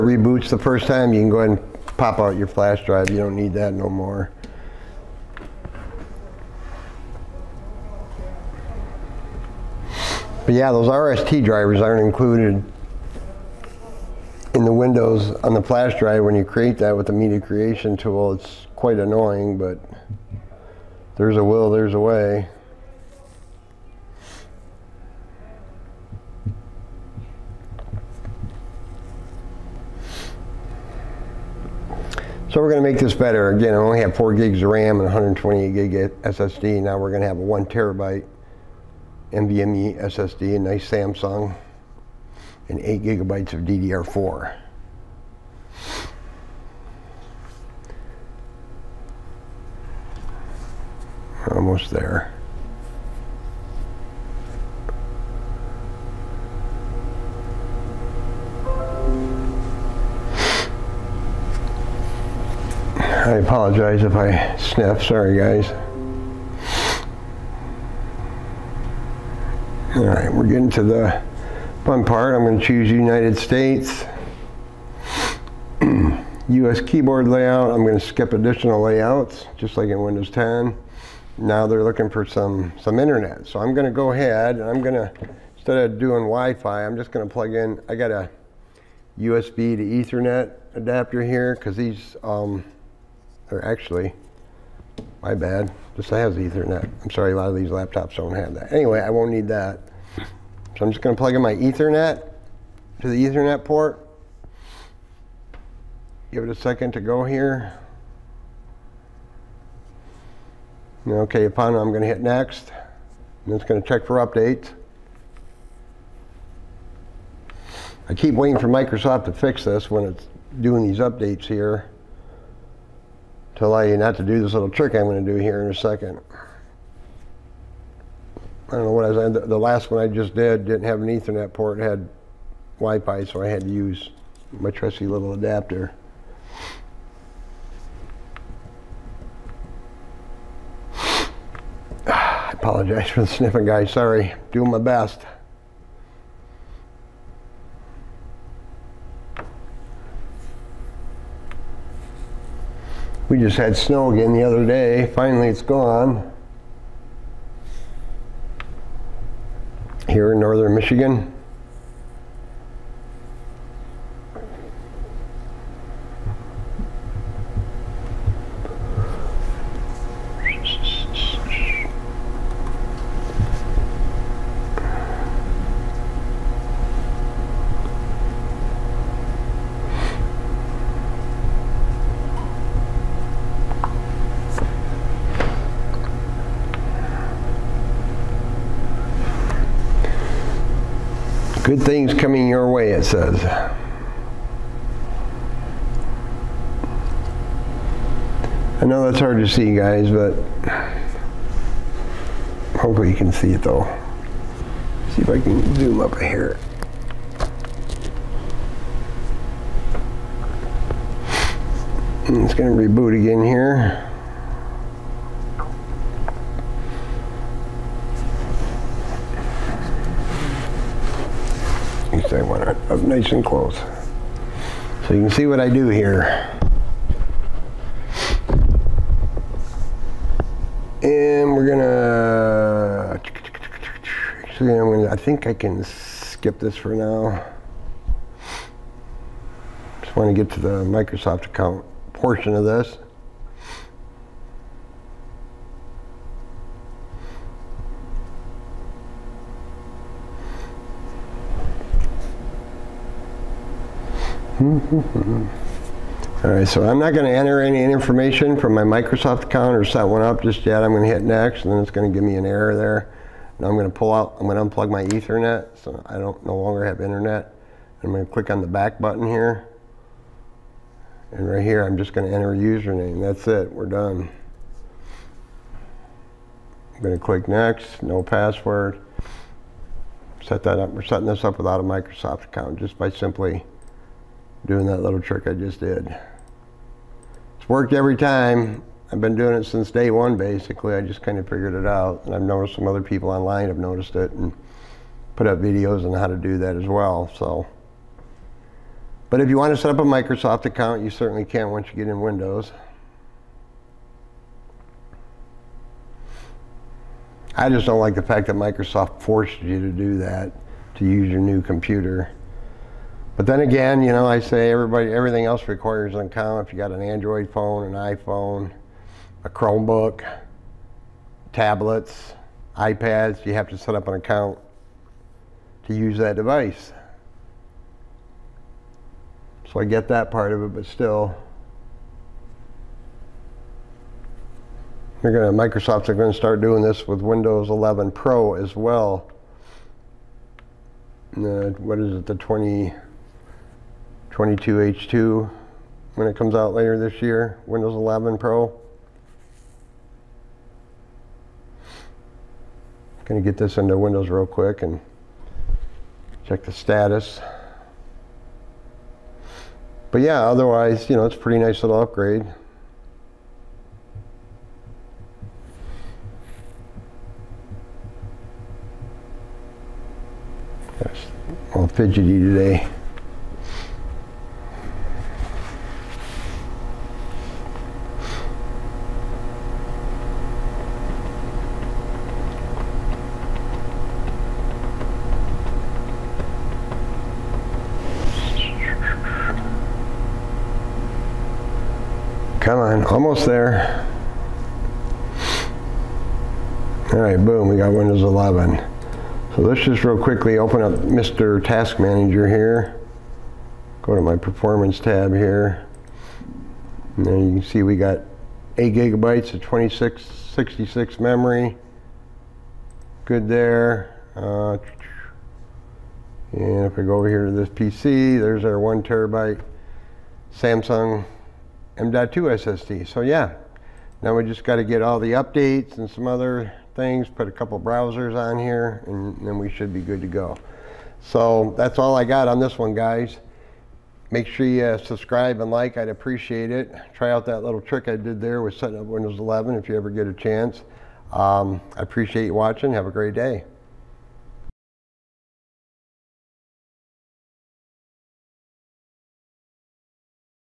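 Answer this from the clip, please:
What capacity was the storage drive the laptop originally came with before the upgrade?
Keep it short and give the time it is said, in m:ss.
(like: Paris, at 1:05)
128 GB, at 0:35.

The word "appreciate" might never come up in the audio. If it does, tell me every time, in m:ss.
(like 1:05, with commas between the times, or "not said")
7:16, 7:22.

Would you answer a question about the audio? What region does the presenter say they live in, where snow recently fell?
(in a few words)
northern Michigan.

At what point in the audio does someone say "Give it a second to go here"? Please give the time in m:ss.
1:46.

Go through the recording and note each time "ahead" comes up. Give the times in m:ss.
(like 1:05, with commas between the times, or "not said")
0:01, 1:24.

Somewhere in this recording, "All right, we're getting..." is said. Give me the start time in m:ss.
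1:09.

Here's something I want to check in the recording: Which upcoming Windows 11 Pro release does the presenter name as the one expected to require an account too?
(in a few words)
22H2.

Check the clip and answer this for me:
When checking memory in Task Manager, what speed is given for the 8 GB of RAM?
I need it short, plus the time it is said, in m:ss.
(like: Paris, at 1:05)
2666, at 6:49.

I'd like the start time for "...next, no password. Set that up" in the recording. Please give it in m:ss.
4:37.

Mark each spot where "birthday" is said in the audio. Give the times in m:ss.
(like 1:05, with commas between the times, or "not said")
not said.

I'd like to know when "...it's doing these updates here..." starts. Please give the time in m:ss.
2:00.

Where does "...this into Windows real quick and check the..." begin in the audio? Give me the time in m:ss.
5:53.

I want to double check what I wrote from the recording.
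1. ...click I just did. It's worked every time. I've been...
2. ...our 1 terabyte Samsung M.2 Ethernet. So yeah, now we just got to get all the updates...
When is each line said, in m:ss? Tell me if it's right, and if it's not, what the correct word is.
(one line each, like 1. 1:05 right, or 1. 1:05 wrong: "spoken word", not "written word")
1. 4:45 wrong: "trick", not "click"
2. 6:58 wrong: "SSD", not "Ethernet".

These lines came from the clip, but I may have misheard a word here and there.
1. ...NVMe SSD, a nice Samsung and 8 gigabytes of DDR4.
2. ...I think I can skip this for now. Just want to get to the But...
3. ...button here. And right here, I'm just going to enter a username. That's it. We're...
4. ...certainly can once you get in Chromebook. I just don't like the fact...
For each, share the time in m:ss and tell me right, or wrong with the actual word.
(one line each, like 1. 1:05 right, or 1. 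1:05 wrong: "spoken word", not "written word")
1. 0:39 right
2. 3:55 wrong: "Microsoft", not "But"
3. 4:28 right
4. 5:01 wrong: "Windows", not "Chromebook".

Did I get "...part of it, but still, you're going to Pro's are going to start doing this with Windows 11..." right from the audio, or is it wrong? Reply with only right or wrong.
wrong.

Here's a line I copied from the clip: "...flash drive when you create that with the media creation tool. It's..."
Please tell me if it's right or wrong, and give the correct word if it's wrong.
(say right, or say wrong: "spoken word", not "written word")
right.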